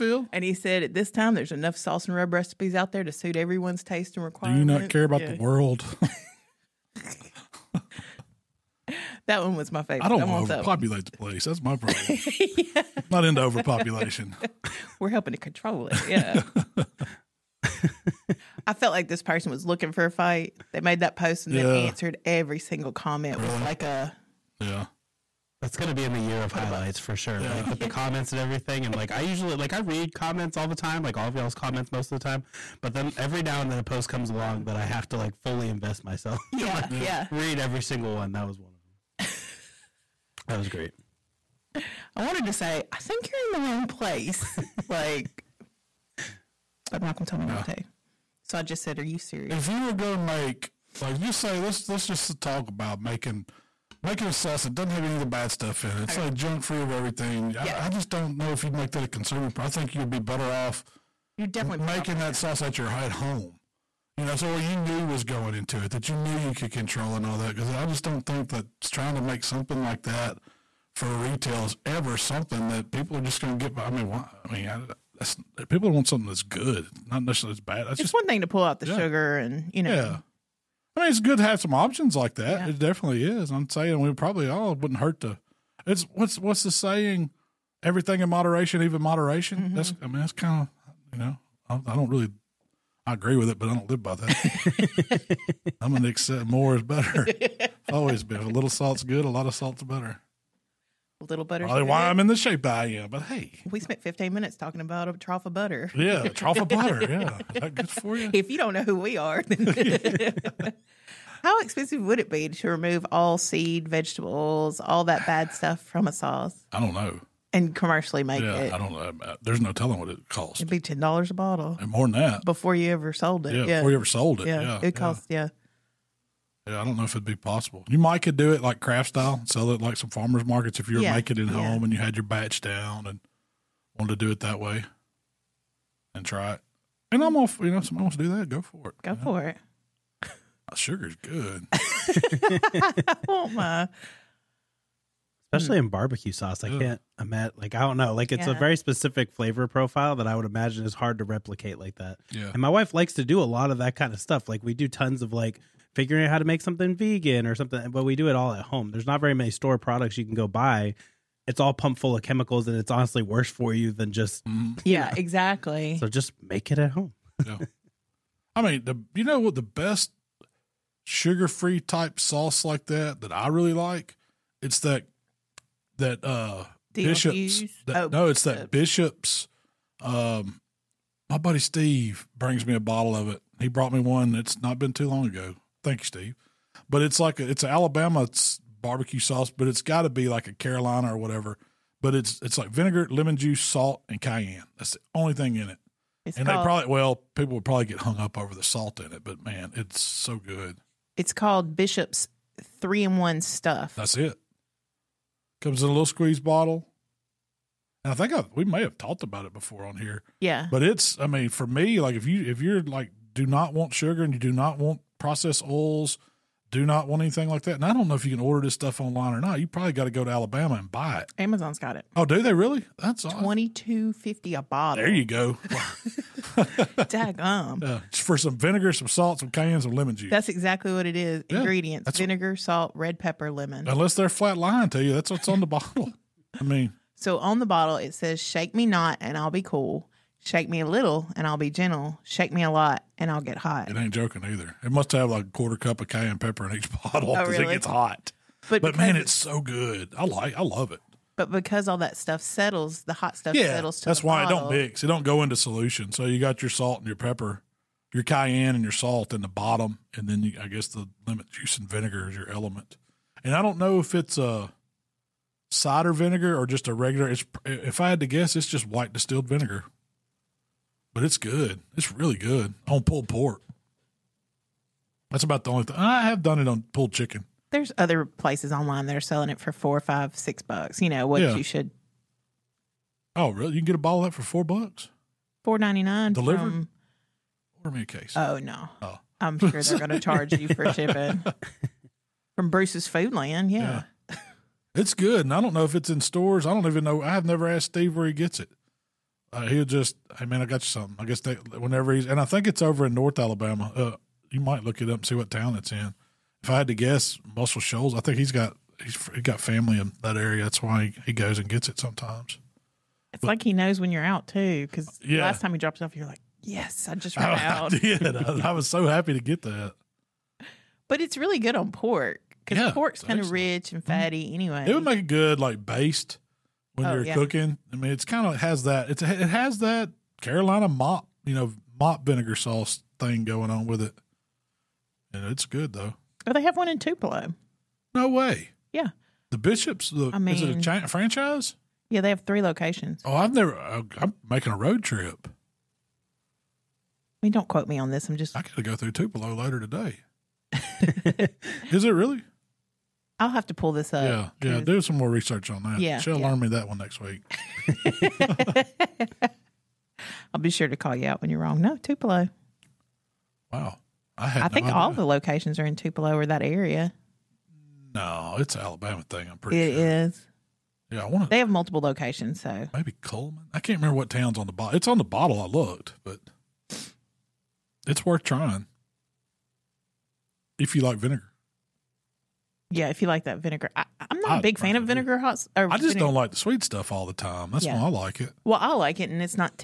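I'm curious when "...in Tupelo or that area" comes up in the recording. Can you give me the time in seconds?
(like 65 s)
365 s.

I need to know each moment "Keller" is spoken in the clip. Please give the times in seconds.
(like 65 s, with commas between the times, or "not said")
not said.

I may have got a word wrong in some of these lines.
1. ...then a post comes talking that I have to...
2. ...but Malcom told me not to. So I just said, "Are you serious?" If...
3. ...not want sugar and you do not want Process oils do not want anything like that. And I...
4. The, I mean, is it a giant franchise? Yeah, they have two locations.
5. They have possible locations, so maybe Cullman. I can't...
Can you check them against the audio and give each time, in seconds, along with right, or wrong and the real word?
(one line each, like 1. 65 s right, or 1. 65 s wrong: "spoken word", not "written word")
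1. 33 s wrong: "along", not "talking"
2. 46 s right
3. 213 s right
4. 340 s wrong: "three", not "two"
5. 371 s wrong: "multiple", not "possible".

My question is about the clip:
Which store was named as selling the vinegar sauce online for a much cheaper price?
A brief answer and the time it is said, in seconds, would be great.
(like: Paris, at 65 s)
Bruce's Foodland, at 292 s.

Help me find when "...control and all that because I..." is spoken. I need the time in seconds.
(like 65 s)
66 s.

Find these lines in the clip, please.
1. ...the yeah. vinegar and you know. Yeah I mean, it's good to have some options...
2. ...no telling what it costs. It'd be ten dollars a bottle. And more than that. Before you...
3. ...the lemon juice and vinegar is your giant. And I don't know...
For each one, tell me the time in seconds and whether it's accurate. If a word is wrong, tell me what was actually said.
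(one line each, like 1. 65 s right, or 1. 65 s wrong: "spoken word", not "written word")
1. 78 s wrong: "sugar", not "vinegar"
2. 119 s right
3. 260 s wrong: "element", not "giant".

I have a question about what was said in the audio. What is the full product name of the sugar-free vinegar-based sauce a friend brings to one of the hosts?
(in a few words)
Bishop's 3 in 1.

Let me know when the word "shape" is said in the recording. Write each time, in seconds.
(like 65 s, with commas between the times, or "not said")
102 s.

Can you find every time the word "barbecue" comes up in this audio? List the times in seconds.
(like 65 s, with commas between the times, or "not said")
145 s, 188 s.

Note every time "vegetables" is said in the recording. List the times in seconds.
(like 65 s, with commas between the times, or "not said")
113 s.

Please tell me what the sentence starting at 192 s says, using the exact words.
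But it's it's like vinegar, lemon juice, salt, and cayenne.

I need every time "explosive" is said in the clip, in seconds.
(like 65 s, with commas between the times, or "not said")
not said.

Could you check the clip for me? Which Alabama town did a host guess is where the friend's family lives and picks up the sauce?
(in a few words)
Muscle Shoals.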